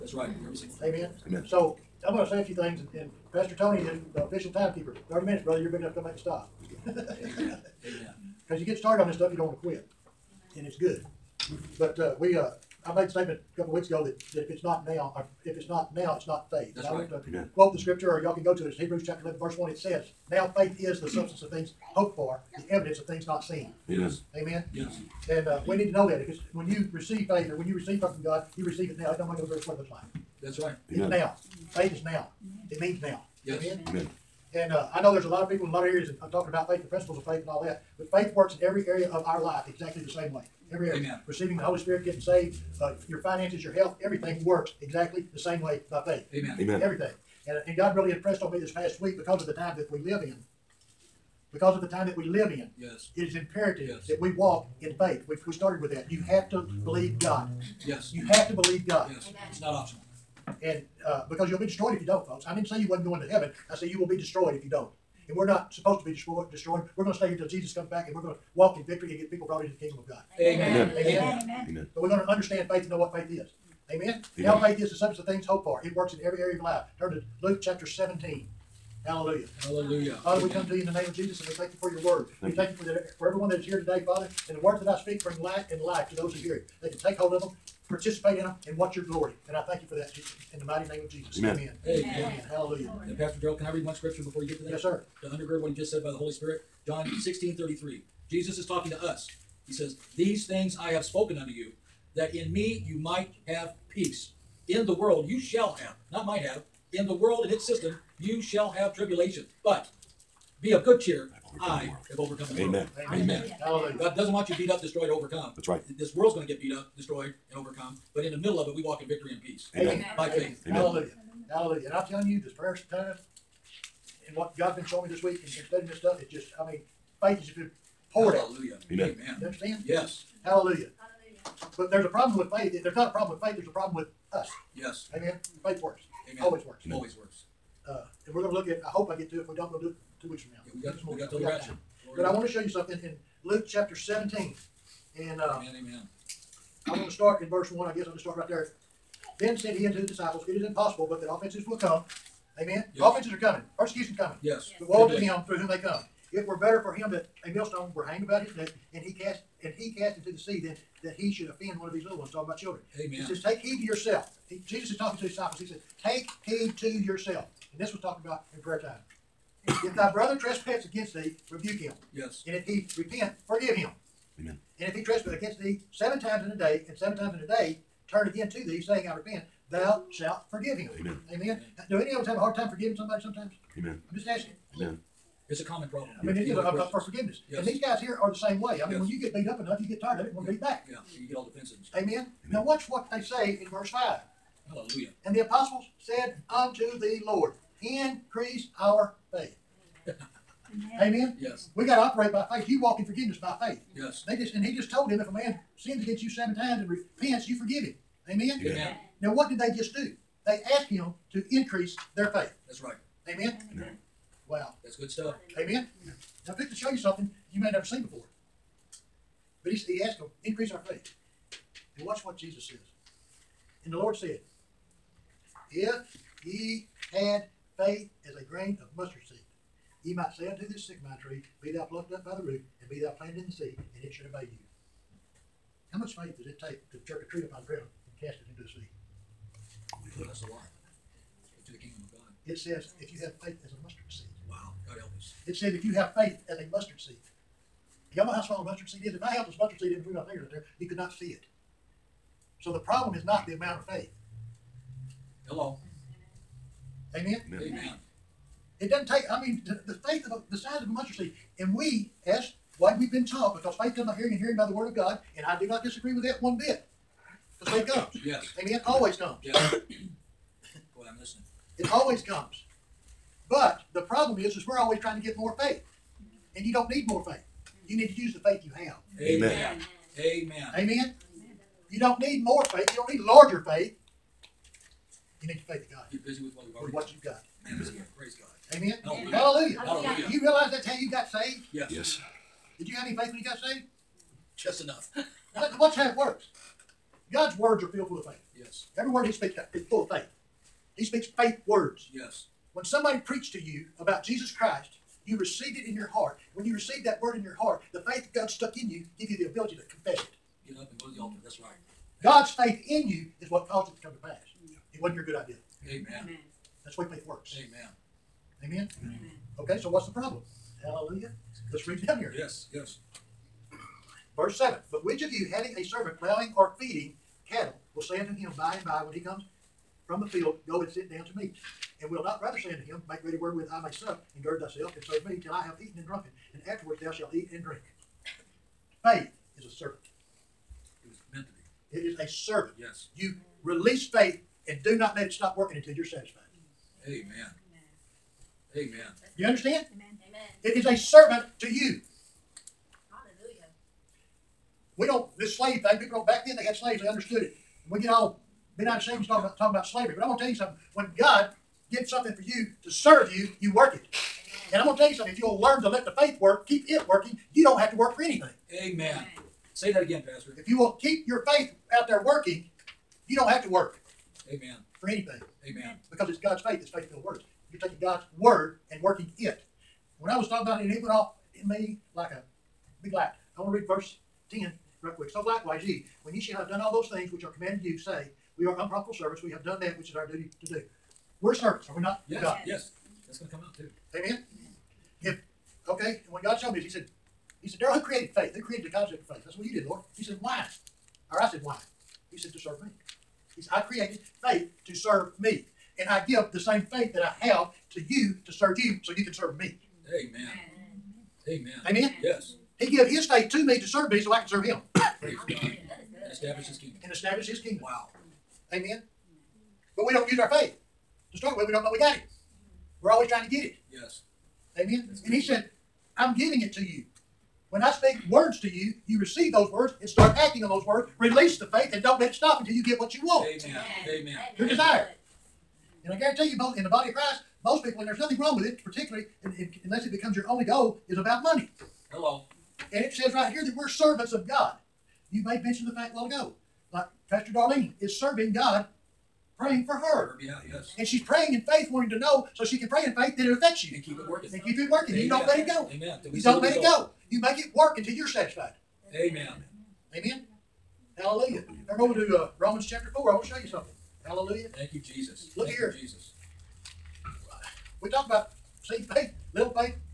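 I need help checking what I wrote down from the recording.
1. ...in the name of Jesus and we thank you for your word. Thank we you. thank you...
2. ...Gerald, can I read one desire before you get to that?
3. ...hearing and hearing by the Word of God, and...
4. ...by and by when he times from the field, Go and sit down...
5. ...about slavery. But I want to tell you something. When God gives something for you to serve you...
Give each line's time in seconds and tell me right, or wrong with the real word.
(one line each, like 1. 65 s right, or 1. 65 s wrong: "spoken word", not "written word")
1. 80 s right
2. 93 s wrong: "scripture", not "desire"
3. 264 s right
4. 328 s wrong: "comes", not "times"
5. 359 s right.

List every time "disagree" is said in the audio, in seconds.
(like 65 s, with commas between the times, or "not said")
265 s.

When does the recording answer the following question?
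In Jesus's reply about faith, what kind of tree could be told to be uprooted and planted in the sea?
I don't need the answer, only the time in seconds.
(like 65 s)
230 s.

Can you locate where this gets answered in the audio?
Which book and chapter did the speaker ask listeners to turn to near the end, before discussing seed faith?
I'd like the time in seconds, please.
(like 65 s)
462 s.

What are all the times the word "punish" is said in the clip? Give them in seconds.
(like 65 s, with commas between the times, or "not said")
not said.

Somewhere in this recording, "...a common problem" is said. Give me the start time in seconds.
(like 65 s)
185 s.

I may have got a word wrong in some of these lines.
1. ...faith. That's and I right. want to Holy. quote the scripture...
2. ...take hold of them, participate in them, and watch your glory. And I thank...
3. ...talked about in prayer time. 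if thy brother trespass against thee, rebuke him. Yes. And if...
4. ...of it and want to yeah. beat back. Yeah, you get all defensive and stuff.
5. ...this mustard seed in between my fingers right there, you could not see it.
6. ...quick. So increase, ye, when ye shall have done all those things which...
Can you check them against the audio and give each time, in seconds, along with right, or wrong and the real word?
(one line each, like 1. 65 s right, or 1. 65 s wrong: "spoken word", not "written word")
1. 16 s wrong: "Amen", not "Holy"
2. 86 s right
3. 167 s right
4. 190 s right
5. 249 s right
6. 385 s wrong: "likewise", not "increase".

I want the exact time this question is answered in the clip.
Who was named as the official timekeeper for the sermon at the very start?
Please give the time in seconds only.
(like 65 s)
3 s.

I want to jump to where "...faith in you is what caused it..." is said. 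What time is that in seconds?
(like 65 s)
312 s.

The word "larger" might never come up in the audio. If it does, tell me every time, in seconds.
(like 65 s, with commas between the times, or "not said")
283 s.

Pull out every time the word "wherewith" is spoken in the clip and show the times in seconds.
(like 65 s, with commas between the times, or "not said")
333 s.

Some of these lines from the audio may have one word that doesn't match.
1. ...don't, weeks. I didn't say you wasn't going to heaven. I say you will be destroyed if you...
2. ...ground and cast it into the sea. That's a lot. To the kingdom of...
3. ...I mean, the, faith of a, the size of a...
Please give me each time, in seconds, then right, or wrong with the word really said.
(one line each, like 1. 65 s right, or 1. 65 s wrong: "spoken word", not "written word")
1. 62 s wrong: "folks", not "weeks"
2. 237 s right
3. 259 s right.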